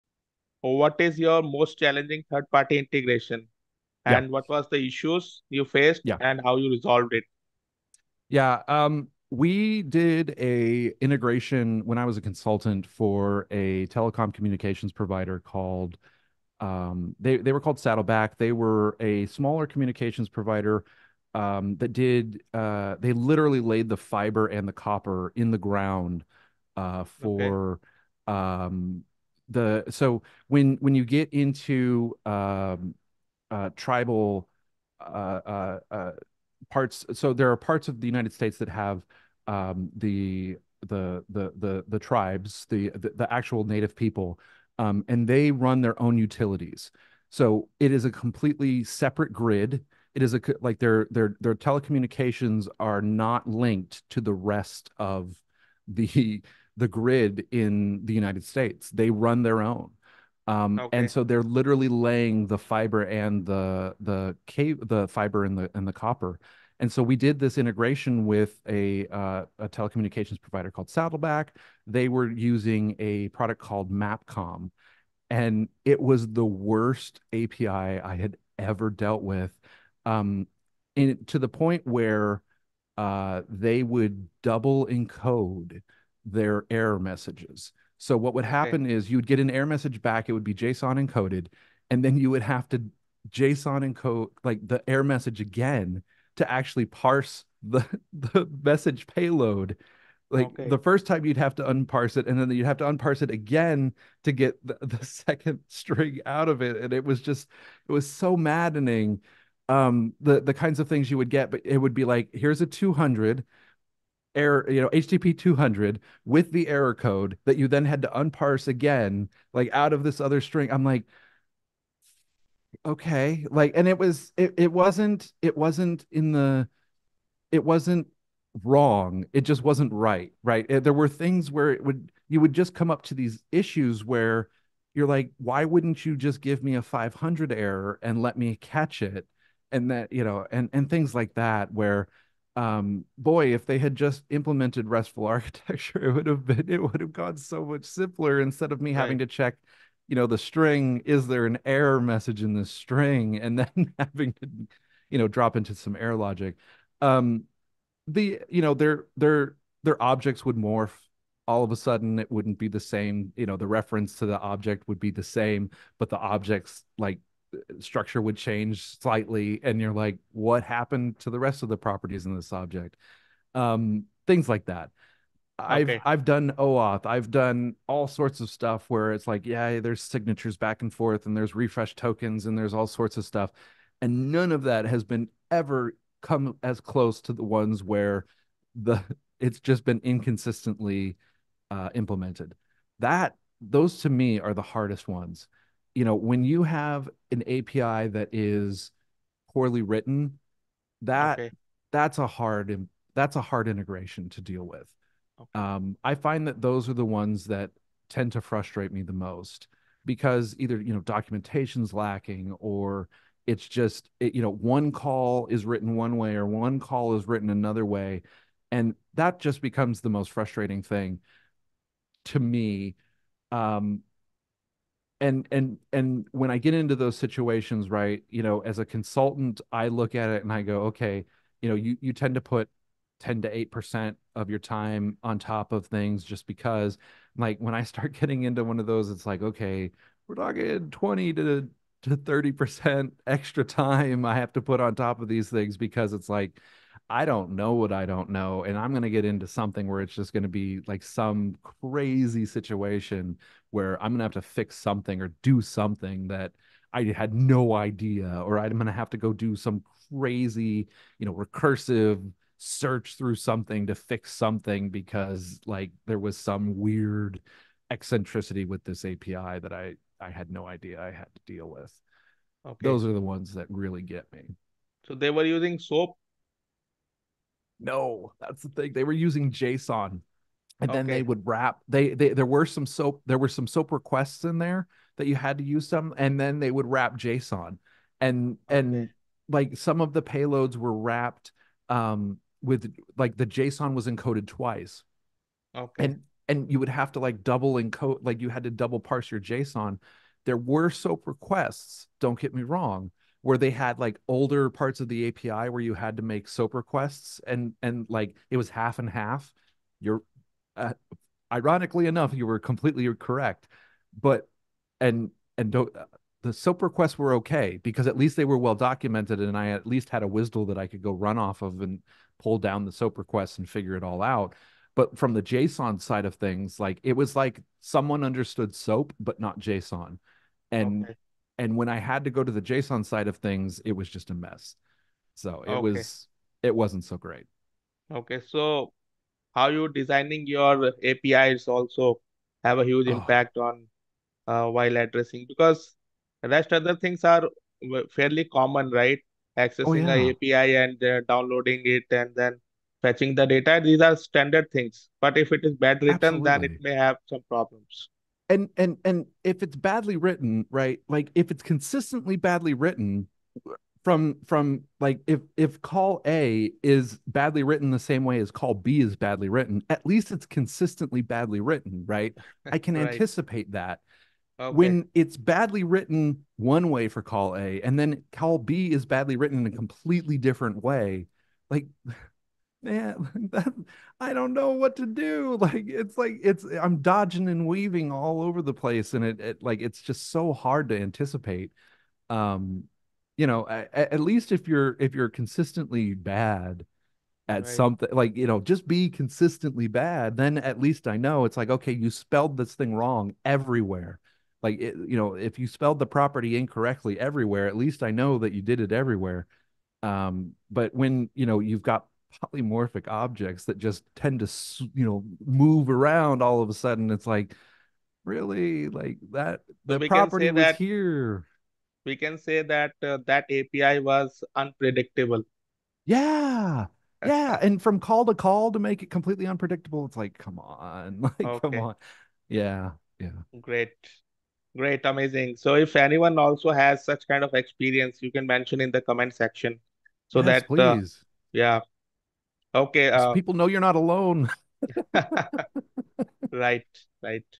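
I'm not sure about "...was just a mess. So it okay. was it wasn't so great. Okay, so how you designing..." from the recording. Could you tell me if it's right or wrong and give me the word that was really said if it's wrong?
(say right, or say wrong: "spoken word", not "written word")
right.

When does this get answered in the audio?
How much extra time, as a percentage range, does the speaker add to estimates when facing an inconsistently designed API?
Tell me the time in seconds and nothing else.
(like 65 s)
240 s.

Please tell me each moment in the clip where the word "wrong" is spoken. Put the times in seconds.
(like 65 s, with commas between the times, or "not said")
128 s, 302 s, 402 s.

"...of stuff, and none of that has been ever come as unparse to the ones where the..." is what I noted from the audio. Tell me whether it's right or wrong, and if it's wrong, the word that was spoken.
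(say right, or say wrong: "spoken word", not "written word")
wrong: "close", not "unparse".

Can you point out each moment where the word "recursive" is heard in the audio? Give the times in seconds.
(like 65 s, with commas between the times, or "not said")
261 s.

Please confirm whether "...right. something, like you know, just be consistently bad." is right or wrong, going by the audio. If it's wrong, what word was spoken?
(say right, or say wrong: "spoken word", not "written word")
right.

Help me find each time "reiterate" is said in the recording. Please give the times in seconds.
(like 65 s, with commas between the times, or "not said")
not said.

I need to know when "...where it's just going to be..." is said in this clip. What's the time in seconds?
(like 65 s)
249 s.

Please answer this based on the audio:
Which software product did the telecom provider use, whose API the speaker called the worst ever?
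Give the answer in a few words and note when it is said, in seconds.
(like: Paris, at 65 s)
Mapcom, at 73 s.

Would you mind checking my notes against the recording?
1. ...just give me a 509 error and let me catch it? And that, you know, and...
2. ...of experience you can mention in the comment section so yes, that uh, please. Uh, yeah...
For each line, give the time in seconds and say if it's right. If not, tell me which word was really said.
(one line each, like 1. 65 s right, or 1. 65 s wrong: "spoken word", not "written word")
1. 136 s wrong: "500", not "509"
2. 437 s right.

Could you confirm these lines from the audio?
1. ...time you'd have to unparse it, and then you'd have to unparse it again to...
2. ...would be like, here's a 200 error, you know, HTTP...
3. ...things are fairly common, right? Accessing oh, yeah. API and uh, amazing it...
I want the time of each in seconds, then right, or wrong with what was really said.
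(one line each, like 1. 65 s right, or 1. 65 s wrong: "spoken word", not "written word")
1. 101 s right
2. 111 s right
3. 346 s wrong: "downloading", not "amazing".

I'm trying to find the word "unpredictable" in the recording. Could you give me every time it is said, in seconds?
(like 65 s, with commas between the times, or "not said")
424 s, 429 s.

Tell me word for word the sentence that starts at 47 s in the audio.
So it is a completely separate grid.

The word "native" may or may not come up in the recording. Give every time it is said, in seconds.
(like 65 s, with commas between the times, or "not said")
43 s.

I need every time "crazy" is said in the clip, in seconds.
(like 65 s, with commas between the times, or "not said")
251 s, 260 s.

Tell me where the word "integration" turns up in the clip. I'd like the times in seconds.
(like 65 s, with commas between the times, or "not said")
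2 s, 11 s, 67 s, 203 s.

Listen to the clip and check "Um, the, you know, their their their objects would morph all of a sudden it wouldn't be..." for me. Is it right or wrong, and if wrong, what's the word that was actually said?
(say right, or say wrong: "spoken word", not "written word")
right.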